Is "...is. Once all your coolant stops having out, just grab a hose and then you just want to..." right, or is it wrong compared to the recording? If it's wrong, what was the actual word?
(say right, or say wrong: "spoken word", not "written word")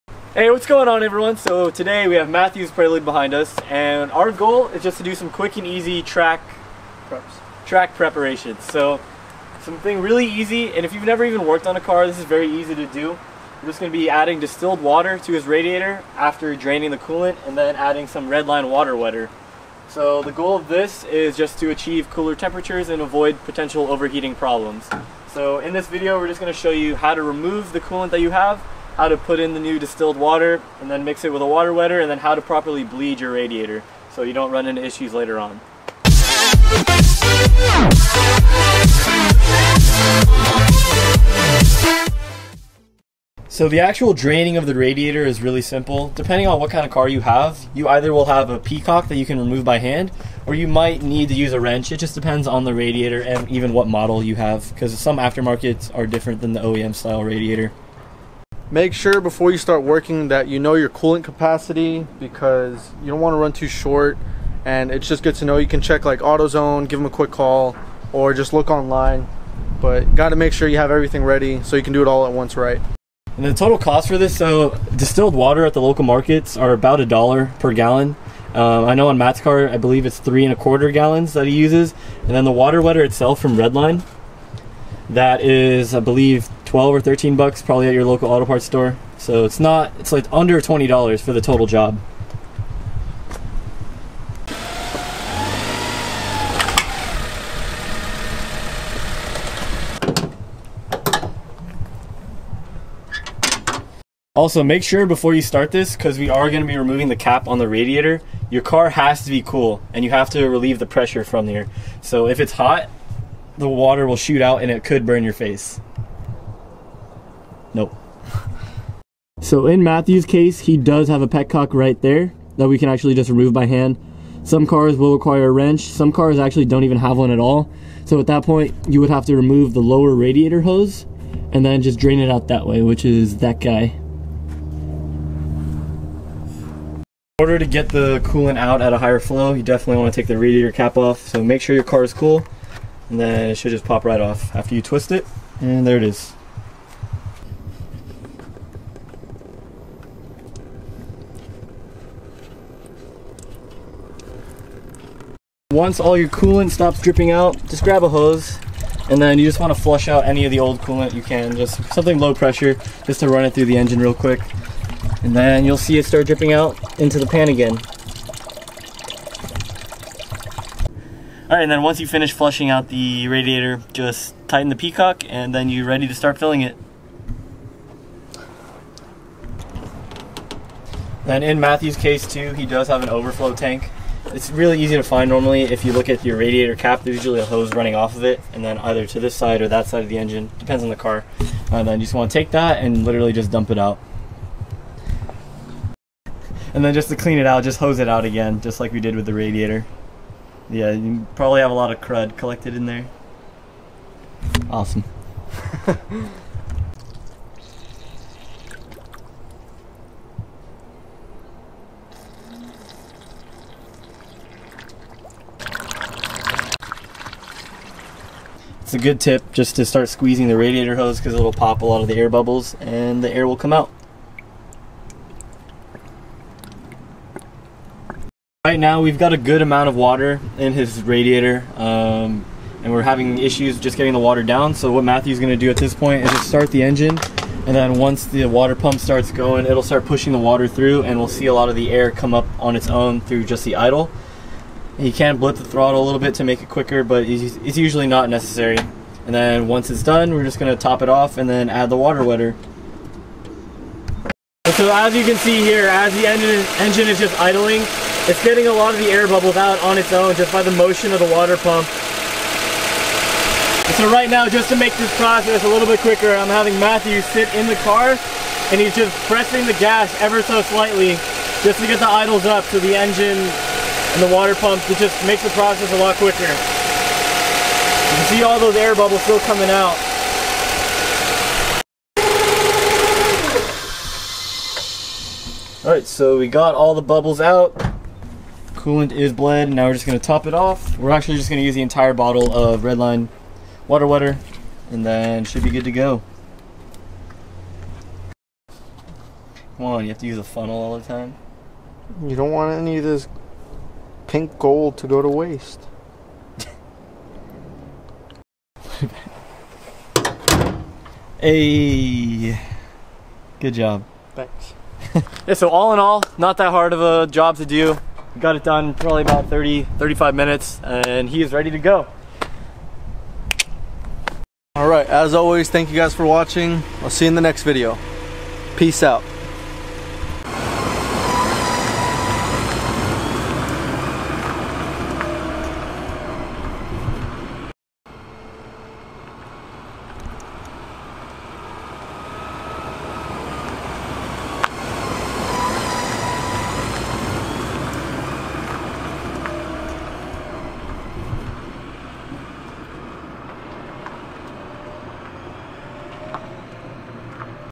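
wrong: "dripping", not "having".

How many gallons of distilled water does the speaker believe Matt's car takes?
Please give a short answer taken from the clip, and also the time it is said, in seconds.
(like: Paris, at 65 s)
3.25 gallons, at 80 s.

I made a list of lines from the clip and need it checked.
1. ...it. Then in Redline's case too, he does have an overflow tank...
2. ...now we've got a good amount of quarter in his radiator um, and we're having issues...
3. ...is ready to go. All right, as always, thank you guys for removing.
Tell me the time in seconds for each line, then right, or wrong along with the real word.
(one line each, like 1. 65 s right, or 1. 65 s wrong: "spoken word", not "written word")
1. 176 s wrong: "Matthew", not "Redline"
2. 228 s wrong: "water", not "quarter"
3. 321 s wrong: "watching", not "removing".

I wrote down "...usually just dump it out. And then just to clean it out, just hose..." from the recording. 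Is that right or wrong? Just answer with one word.
wrong.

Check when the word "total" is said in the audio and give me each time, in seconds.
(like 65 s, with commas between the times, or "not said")
73 s, 91 s.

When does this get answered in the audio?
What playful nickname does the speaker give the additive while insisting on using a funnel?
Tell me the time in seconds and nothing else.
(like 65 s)
304 s.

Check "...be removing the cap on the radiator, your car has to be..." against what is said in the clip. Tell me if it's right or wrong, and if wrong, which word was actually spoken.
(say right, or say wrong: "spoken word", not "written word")
right.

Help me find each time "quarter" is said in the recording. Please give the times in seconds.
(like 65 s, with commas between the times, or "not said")
80 s.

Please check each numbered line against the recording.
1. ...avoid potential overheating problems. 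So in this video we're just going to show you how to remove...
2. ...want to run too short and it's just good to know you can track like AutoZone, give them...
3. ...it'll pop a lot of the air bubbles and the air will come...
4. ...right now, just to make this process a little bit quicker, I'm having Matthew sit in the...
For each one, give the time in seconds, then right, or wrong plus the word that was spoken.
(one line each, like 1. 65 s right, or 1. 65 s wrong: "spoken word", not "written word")
1. 23 s right
2. 63 s wrong: "check", not "track"
3. 221 s right
4. 264 s right.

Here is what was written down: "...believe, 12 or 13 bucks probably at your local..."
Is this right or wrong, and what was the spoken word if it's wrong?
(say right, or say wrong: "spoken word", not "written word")
right.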